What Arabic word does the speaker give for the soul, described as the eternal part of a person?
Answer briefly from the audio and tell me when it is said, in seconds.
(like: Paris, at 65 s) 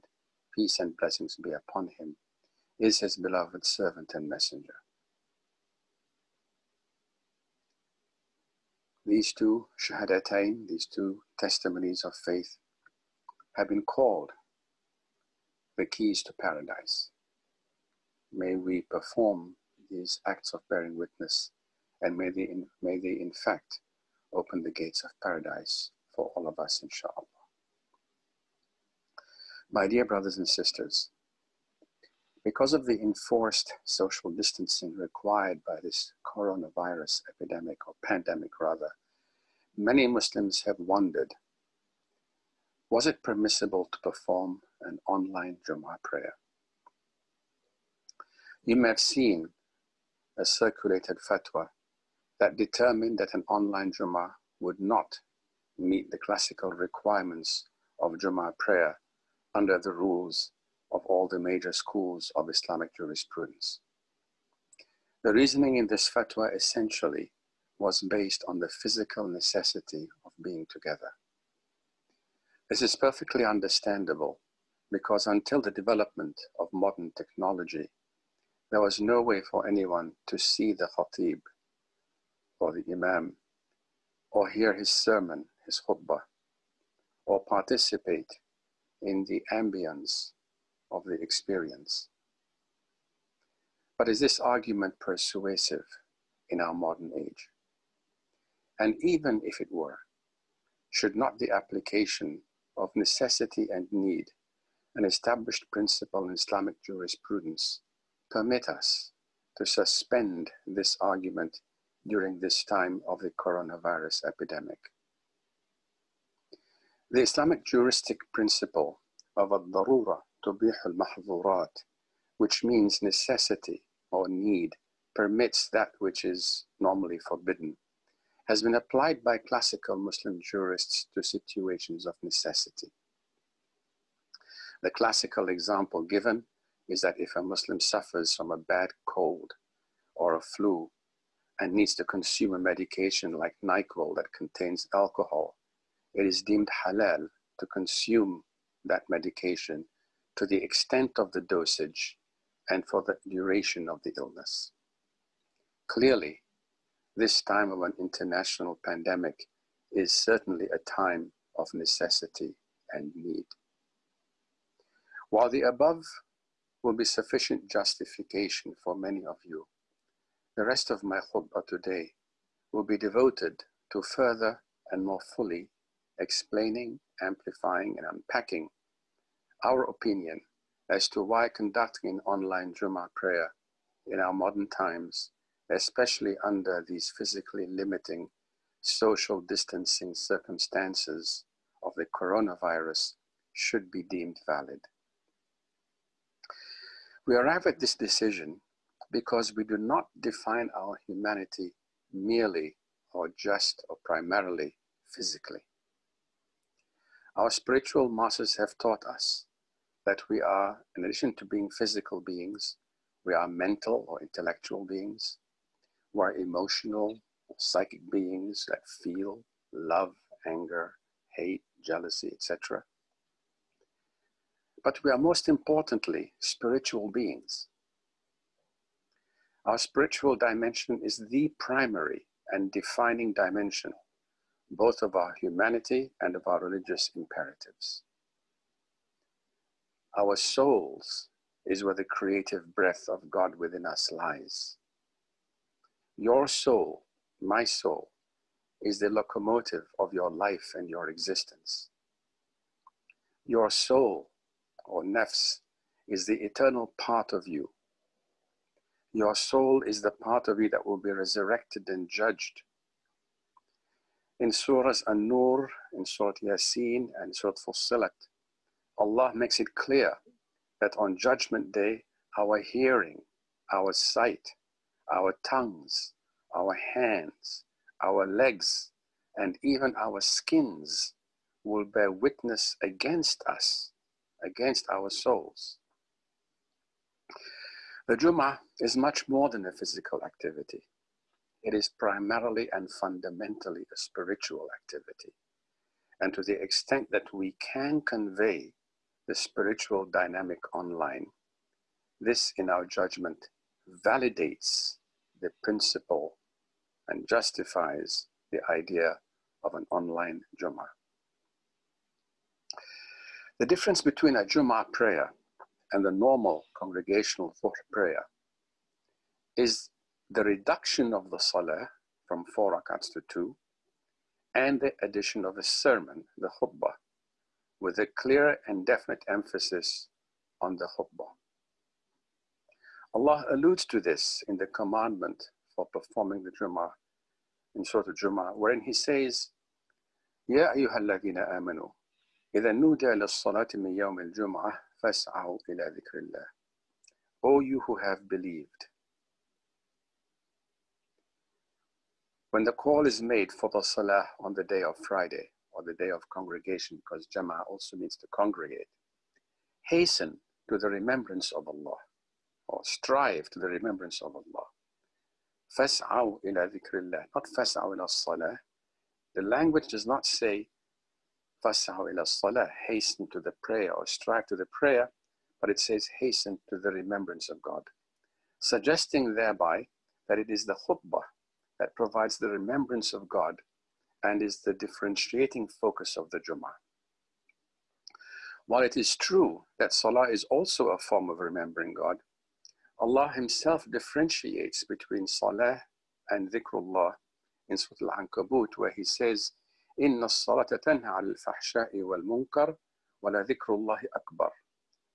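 nafs, at 255 s.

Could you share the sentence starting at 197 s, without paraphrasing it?
We arrive at this decision because we do not define our humanity merely or just or primarily physically.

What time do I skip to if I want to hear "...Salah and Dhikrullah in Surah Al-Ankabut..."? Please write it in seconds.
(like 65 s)
395 s.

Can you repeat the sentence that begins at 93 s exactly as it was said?
But is this argument persuasive in our modern age?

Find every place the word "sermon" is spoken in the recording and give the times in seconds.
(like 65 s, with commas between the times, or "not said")
84 s, 325 s.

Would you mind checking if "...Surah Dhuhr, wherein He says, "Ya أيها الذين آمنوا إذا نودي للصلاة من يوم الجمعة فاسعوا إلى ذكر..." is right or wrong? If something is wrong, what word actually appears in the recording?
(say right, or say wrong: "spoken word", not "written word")
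wrong: "Jummah", not "Dhuhr".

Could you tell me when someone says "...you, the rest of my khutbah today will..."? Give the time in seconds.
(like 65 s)
169 s.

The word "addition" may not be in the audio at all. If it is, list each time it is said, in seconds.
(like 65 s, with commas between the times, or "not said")
211 s, 325 s.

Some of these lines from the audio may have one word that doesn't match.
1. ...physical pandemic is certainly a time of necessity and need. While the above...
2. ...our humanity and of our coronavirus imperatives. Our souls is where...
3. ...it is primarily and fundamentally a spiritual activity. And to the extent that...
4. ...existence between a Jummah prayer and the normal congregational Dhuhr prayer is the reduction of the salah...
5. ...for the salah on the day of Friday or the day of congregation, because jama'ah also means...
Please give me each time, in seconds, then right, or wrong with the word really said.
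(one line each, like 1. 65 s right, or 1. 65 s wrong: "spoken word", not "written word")
1. 157 s wrong: "international", not "physical"
2. 235 s wrong: "religious", not "coronavirus"
3. 291 s right
4. 313 s wrong: "difference", not "existence"
5. 353 s right.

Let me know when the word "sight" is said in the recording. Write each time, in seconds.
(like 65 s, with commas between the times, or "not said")
273 s.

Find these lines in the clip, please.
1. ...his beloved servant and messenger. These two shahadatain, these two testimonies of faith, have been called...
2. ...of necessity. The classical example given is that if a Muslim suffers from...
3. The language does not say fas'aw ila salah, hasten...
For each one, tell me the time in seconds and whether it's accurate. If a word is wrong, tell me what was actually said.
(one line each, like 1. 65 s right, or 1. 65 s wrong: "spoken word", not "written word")
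1. 2 s right
2. 132 s right
3. 369 s right.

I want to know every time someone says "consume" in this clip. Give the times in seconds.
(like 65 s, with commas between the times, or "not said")
142 s, 147 s.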